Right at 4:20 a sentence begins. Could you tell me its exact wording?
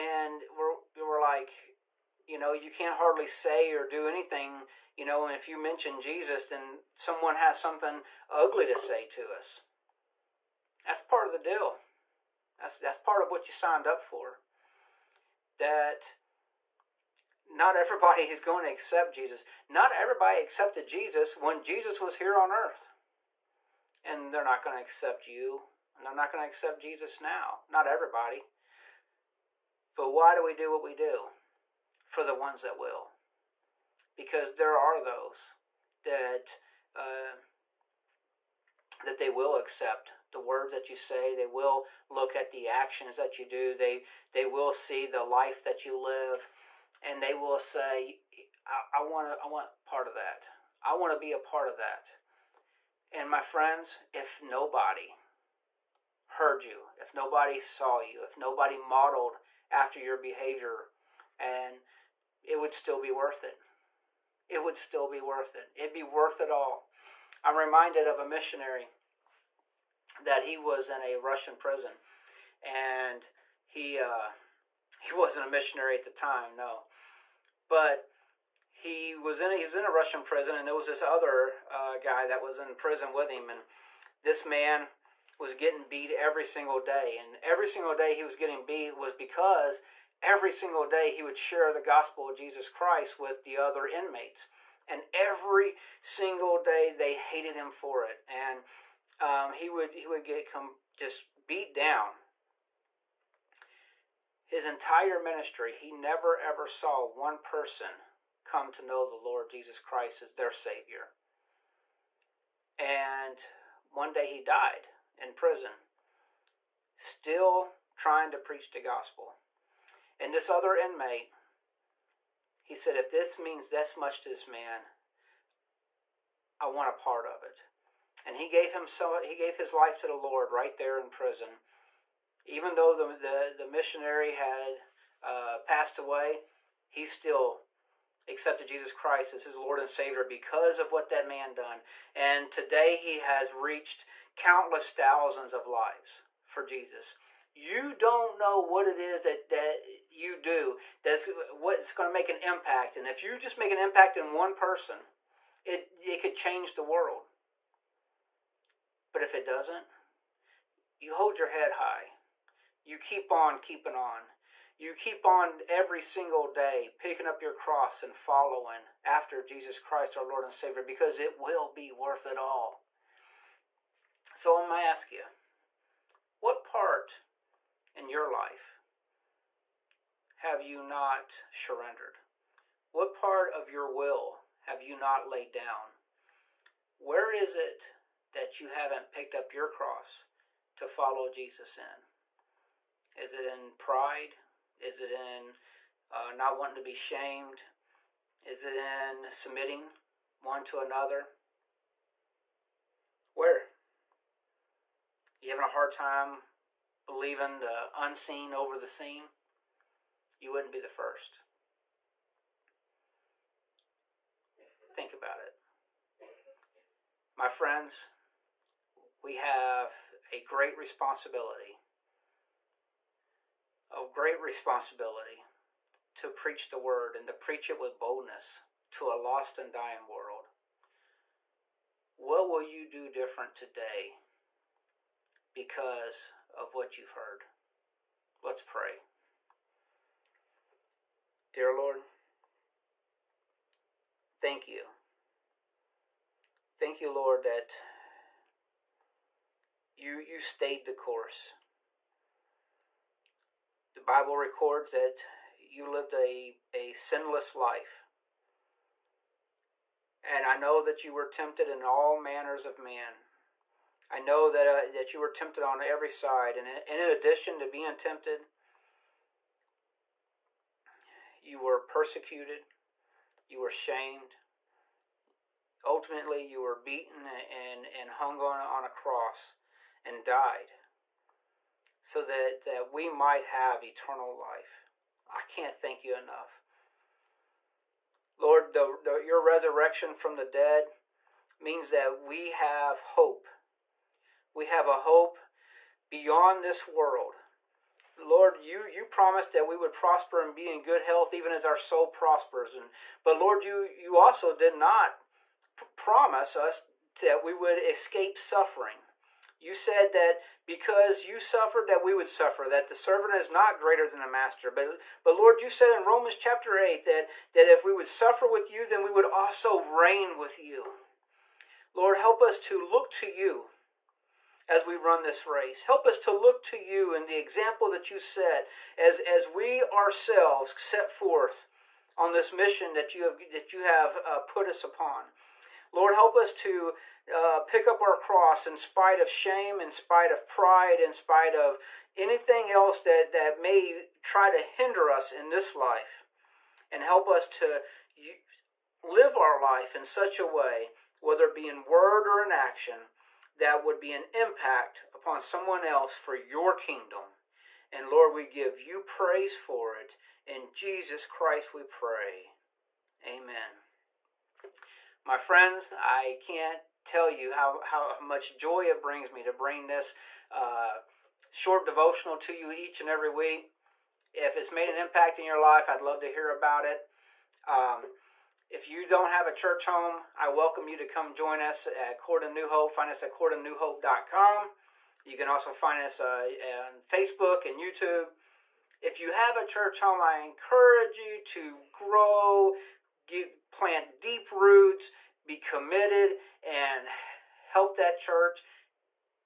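And I know that you were tempted in all manners of men.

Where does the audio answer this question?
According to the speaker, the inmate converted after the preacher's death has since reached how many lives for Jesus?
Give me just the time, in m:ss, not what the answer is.
2:24.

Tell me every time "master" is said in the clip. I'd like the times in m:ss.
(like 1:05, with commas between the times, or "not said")
5:14.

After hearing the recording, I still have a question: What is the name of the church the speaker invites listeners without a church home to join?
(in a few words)
Corydon New Hope.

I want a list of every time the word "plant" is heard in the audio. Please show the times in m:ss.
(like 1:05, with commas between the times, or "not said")
6:33.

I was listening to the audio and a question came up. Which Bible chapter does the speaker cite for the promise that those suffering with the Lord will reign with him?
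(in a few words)
Romans chapter 8.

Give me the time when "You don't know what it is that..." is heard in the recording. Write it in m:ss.
2:27.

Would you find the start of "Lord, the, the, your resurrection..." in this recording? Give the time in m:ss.
4:48.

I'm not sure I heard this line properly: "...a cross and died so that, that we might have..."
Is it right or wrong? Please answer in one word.
right.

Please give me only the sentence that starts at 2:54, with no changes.
So I'm going to ask you, what part in your life have you not surrendered?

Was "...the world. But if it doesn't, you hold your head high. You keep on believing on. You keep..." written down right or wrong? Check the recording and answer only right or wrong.
wrong.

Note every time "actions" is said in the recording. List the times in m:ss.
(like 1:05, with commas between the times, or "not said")
0:42, 5:52.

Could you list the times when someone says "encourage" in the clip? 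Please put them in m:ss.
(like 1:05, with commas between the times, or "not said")
6:30.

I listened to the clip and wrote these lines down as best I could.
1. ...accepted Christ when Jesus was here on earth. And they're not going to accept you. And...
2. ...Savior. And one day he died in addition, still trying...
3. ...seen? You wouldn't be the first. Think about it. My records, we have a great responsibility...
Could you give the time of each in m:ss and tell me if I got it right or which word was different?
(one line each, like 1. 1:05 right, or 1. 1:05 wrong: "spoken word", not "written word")
1. 0:20 wrong: "Jesus", not "Christ"
2. 1:50 wrong: "prison", not "addition"
3. 3:28 wrong: "friends", not "records".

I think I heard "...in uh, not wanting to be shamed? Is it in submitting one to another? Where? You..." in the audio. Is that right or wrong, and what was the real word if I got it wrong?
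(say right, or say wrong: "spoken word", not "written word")
right.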